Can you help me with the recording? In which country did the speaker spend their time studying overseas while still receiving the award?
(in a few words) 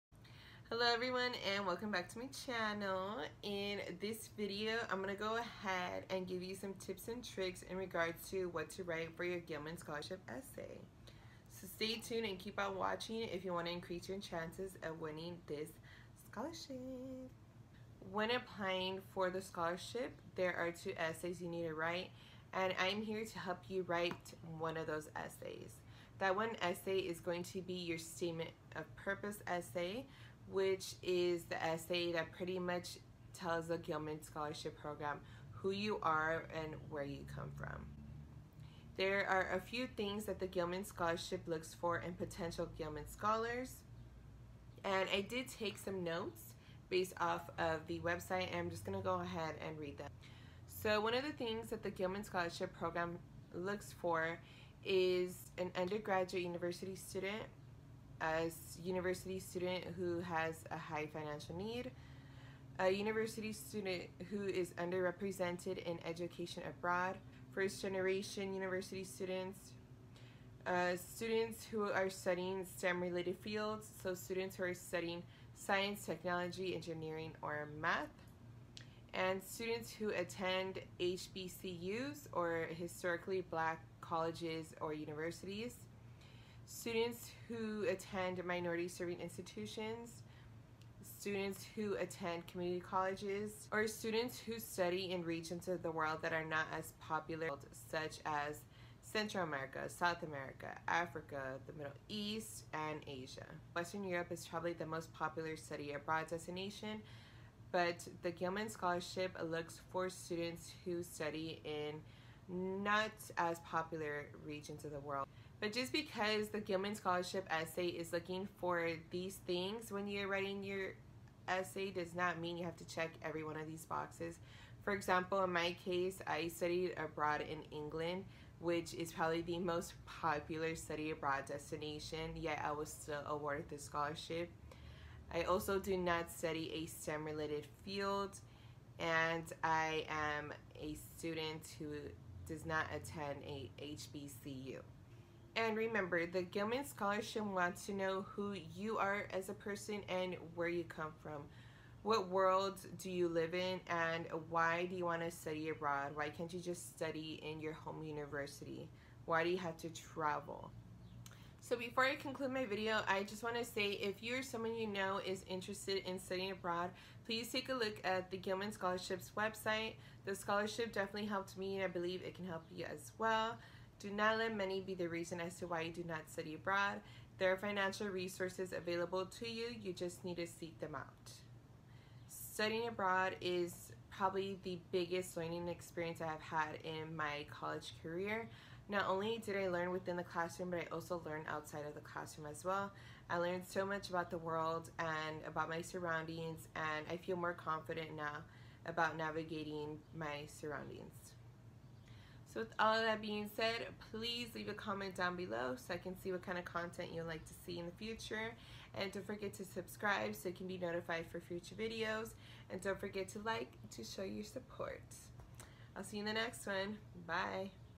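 England.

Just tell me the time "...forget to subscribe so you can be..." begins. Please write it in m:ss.
3:29.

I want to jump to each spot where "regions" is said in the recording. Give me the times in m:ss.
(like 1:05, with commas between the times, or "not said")
1:35, 1:54.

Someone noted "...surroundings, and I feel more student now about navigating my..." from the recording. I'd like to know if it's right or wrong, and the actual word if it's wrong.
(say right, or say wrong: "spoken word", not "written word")
wrong: "confident", not "student".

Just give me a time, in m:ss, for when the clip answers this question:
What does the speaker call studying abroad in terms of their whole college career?
3:04.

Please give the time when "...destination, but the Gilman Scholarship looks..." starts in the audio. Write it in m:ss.
1:46.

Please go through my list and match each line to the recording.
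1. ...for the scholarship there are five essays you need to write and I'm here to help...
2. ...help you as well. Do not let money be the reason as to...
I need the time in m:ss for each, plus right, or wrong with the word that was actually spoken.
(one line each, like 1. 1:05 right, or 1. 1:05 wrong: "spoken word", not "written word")
1. 0:19 wrong: "two", not "five"
2. 2:52 right.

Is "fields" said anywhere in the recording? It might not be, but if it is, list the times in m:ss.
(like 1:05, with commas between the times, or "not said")
1:13, 2:17.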